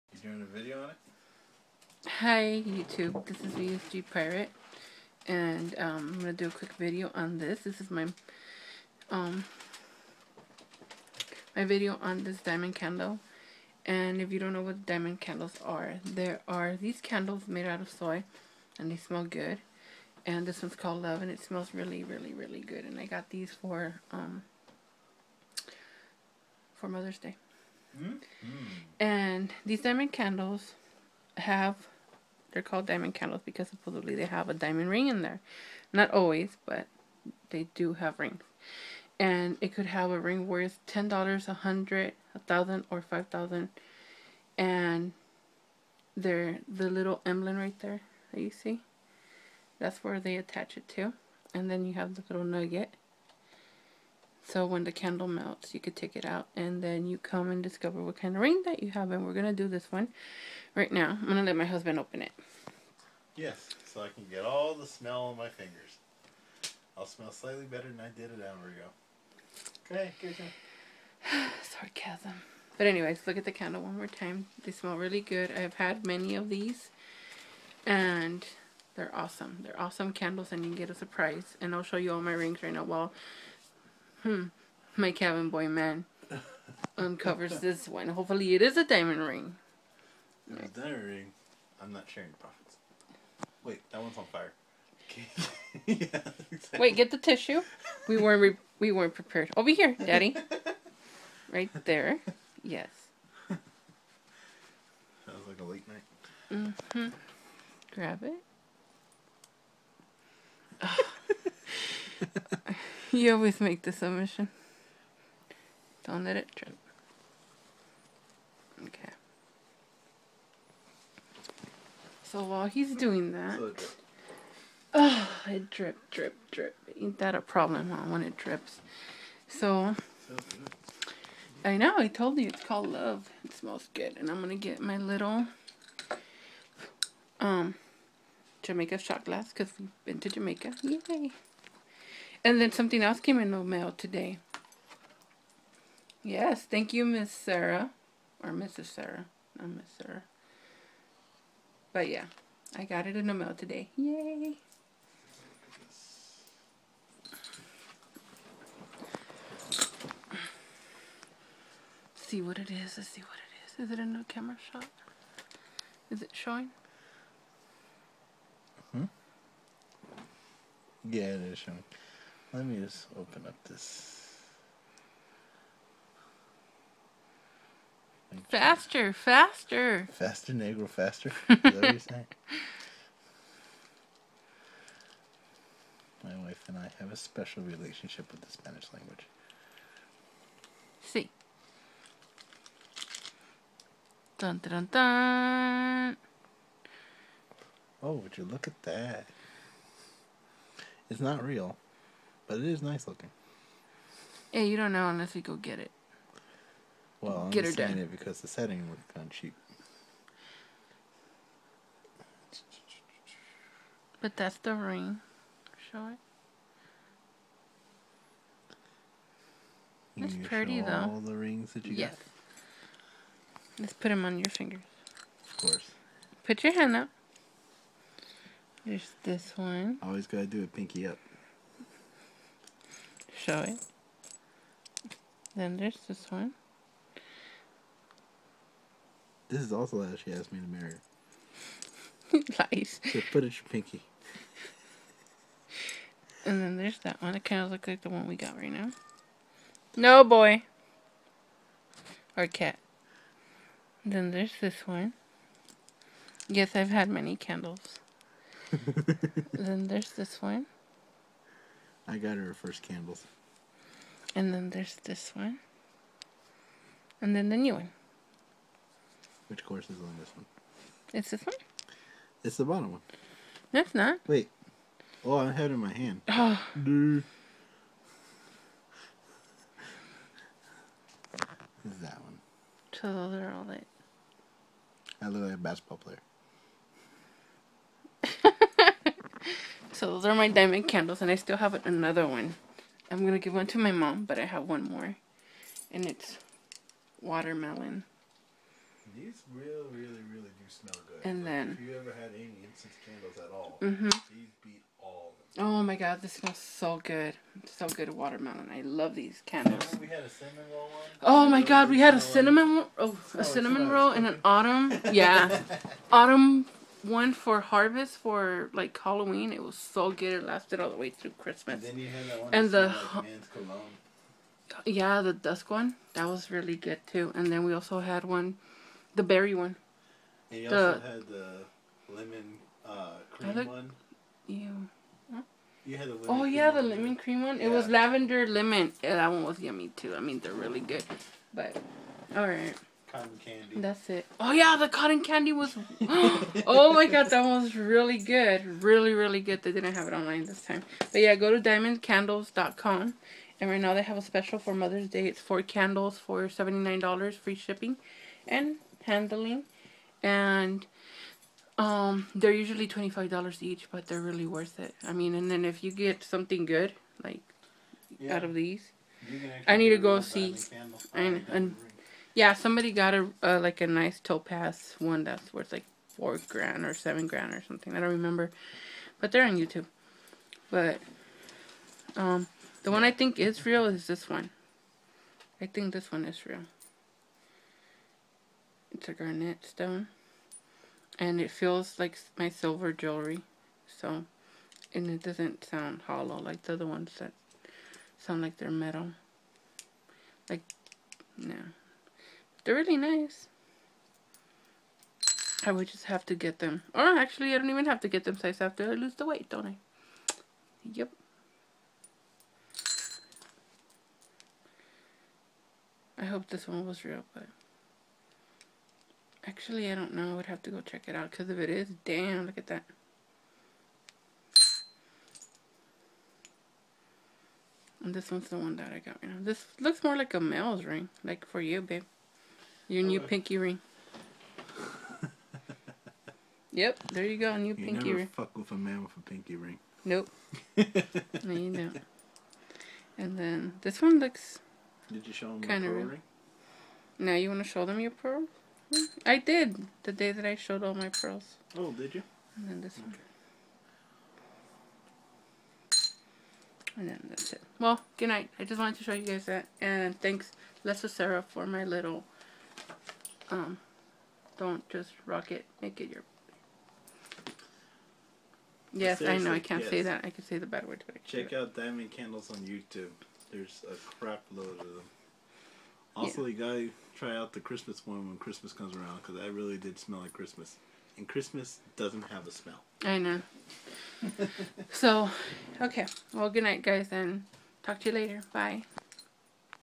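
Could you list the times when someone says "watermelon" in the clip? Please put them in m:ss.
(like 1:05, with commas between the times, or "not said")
4:57, 5:08.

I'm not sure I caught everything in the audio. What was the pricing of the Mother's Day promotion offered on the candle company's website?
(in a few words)
4 candles for 79 dollars.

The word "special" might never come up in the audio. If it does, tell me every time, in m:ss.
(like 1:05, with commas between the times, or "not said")
3:07, 5:54.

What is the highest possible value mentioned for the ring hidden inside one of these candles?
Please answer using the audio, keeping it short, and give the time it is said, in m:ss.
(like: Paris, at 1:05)
5,000 dollars, at 0:43.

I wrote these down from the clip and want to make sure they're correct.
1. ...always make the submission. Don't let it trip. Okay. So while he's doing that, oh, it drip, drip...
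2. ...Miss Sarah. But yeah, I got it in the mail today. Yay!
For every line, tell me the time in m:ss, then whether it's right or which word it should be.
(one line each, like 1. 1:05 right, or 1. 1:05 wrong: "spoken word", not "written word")
1. 1:53 right
2. 2:29 right.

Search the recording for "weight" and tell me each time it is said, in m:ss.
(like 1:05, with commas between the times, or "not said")
6:49.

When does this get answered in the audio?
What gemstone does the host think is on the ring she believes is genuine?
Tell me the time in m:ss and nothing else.
6:29.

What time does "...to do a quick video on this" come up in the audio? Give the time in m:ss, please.
0:06.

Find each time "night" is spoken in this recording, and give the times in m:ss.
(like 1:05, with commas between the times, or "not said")
1:45, 7:38, 8:06.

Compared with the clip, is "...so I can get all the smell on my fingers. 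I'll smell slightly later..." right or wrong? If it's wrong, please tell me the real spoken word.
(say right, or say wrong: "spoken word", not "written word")
wrong: "better", not "later".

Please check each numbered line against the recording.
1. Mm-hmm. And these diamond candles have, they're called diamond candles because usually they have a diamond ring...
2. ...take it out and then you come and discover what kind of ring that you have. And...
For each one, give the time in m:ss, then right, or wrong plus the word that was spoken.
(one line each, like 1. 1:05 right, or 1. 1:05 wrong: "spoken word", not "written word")
1. 0:27 wrong: "supposedly", not "usually"
2. 0:55 right.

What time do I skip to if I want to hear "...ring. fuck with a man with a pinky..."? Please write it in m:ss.
7:18.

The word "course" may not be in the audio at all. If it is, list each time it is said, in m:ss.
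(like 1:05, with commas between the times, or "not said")
3:45, 4:29.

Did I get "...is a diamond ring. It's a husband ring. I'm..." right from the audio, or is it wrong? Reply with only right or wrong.
wrong.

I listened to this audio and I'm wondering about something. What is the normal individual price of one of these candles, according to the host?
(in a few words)
$25.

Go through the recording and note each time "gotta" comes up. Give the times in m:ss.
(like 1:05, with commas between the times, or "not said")
3:50, 7:56.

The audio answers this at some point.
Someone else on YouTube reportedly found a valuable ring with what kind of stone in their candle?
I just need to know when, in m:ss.
6:14.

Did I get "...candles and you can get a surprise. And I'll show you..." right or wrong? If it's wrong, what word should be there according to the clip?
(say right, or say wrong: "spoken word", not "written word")
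right.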